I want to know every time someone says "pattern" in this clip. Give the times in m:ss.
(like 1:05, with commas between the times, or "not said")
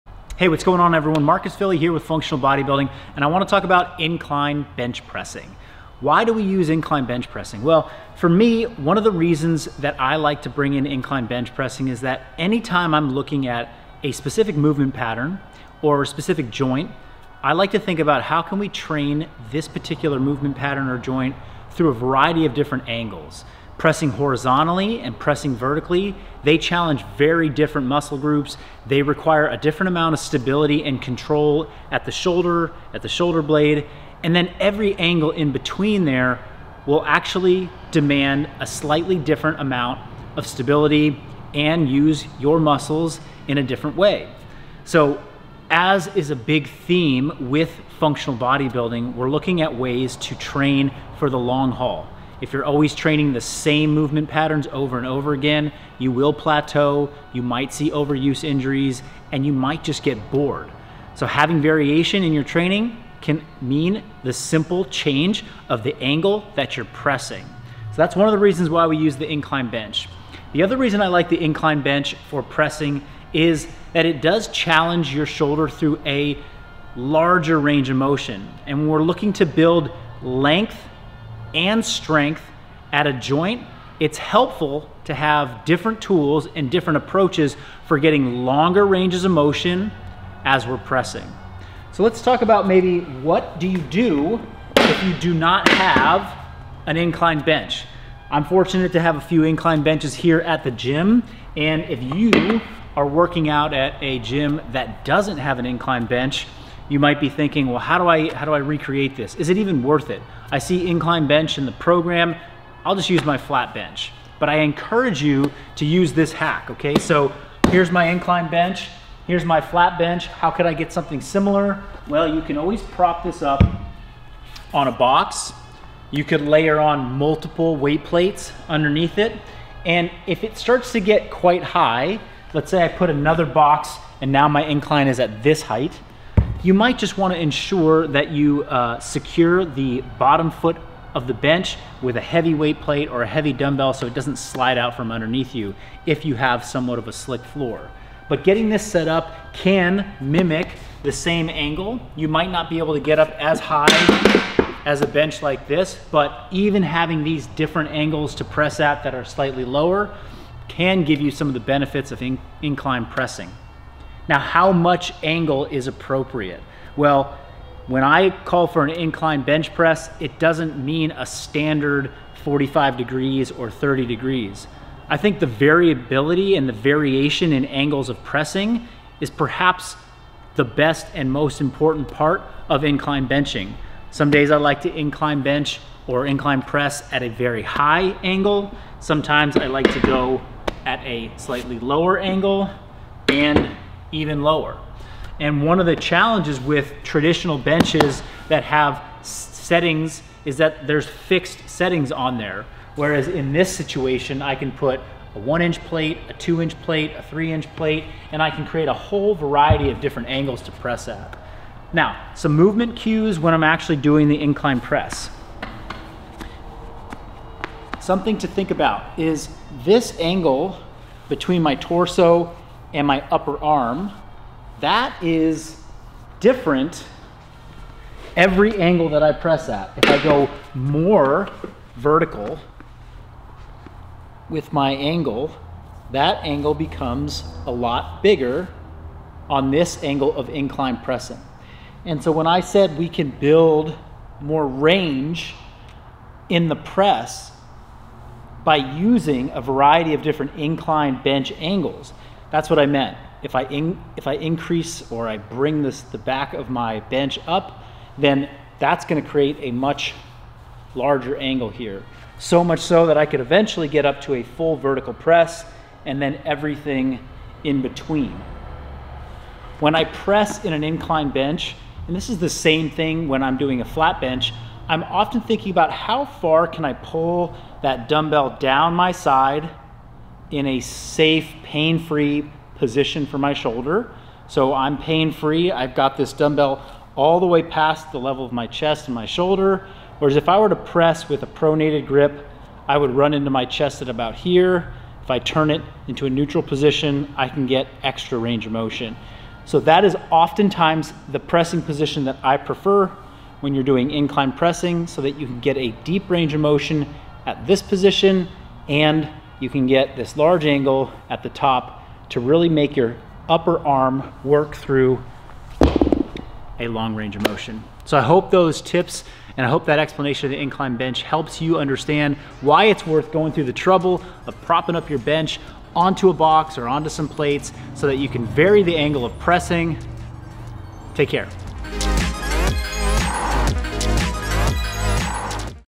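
0:14, 0:20, 0:54.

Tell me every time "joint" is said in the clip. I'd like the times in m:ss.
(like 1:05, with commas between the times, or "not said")
0:16, 0:20, 1:23.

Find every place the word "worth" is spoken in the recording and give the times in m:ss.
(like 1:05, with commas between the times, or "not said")
1:49, 5:23.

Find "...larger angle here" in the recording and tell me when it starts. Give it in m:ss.
4:20.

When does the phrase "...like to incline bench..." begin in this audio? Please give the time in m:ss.
3:04.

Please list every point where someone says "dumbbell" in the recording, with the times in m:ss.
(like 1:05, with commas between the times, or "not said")
2:23, 4:38, 4:46.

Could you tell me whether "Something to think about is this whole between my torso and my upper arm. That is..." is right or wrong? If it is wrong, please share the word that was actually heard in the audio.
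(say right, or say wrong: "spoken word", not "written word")
wrong: "angle", not "whole".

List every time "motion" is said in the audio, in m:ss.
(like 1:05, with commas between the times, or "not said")
1:17, 1:29, 4:58, 5:06, 5:17.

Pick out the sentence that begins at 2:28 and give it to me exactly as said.
But getting this set up can mimic the same angle.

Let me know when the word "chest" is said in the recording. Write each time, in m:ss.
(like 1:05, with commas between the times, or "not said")
4:48, 4:53.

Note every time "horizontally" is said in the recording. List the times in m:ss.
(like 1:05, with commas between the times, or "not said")
0:24.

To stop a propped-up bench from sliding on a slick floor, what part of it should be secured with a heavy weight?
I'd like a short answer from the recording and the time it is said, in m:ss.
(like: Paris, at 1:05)
the bottom foot, at 2:20.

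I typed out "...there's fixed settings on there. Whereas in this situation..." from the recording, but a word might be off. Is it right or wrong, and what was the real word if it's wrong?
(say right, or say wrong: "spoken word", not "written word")
right.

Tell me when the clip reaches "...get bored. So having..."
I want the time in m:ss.
1:00.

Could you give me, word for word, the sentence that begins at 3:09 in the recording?
Sometimes I like to go at a slightly lower angle and even lower.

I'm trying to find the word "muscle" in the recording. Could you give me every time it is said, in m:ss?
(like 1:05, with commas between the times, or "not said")
0:27, 0:42.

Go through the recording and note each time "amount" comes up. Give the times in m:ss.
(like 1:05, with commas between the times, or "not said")
0:29, 0:39.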